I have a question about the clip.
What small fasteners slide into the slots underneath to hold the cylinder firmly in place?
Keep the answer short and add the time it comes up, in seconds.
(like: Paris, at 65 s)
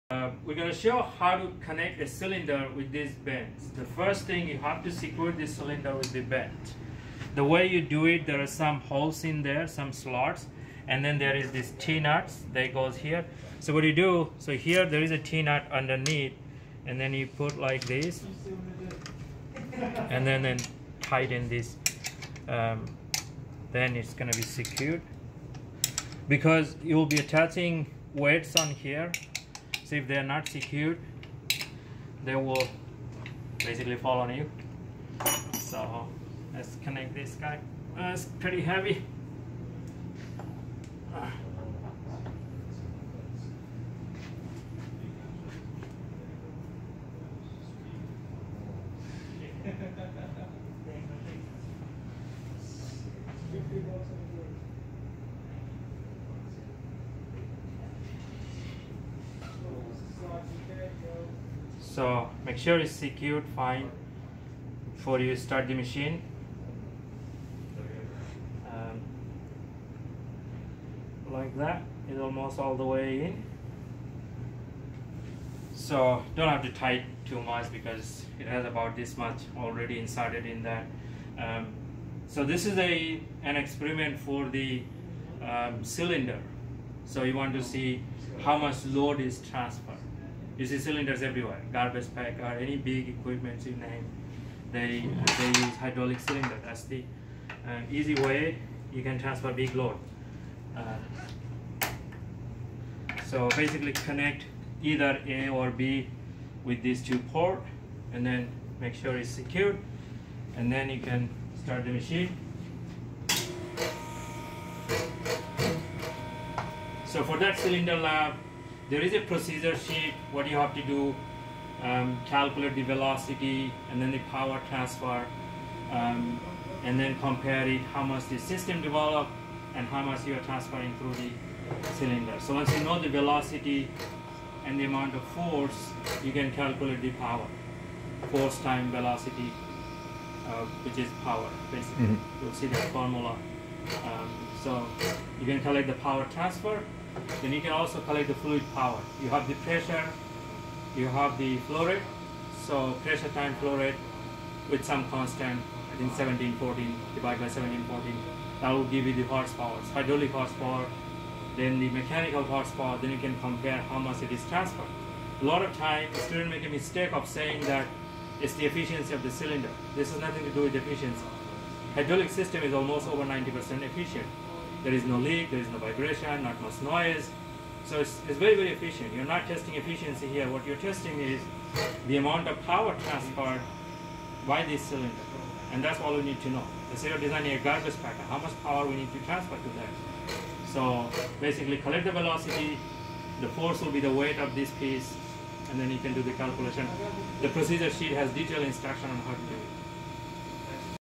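T-nuts, at 11 s.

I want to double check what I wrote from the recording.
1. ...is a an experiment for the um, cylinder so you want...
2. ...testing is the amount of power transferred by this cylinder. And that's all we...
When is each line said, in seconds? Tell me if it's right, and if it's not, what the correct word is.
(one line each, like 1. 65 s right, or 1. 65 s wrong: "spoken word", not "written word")
1. 82 s right
2. 180 s right.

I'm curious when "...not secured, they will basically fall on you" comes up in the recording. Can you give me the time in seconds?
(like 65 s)
30 s.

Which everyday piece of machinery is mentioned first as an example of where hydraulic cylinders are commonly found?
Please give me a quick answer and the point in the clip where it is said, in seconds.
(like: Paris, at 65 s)
Garbage pack, at 91 s.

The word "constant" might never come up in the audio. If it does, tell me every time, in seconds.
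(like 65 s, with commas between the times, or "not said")
155 s.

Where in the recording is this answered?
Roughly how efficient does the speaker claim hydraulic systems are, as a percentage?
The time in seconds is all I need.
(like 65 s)
173 s.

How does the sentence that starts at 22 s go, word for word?
Um, then it's going to be secured.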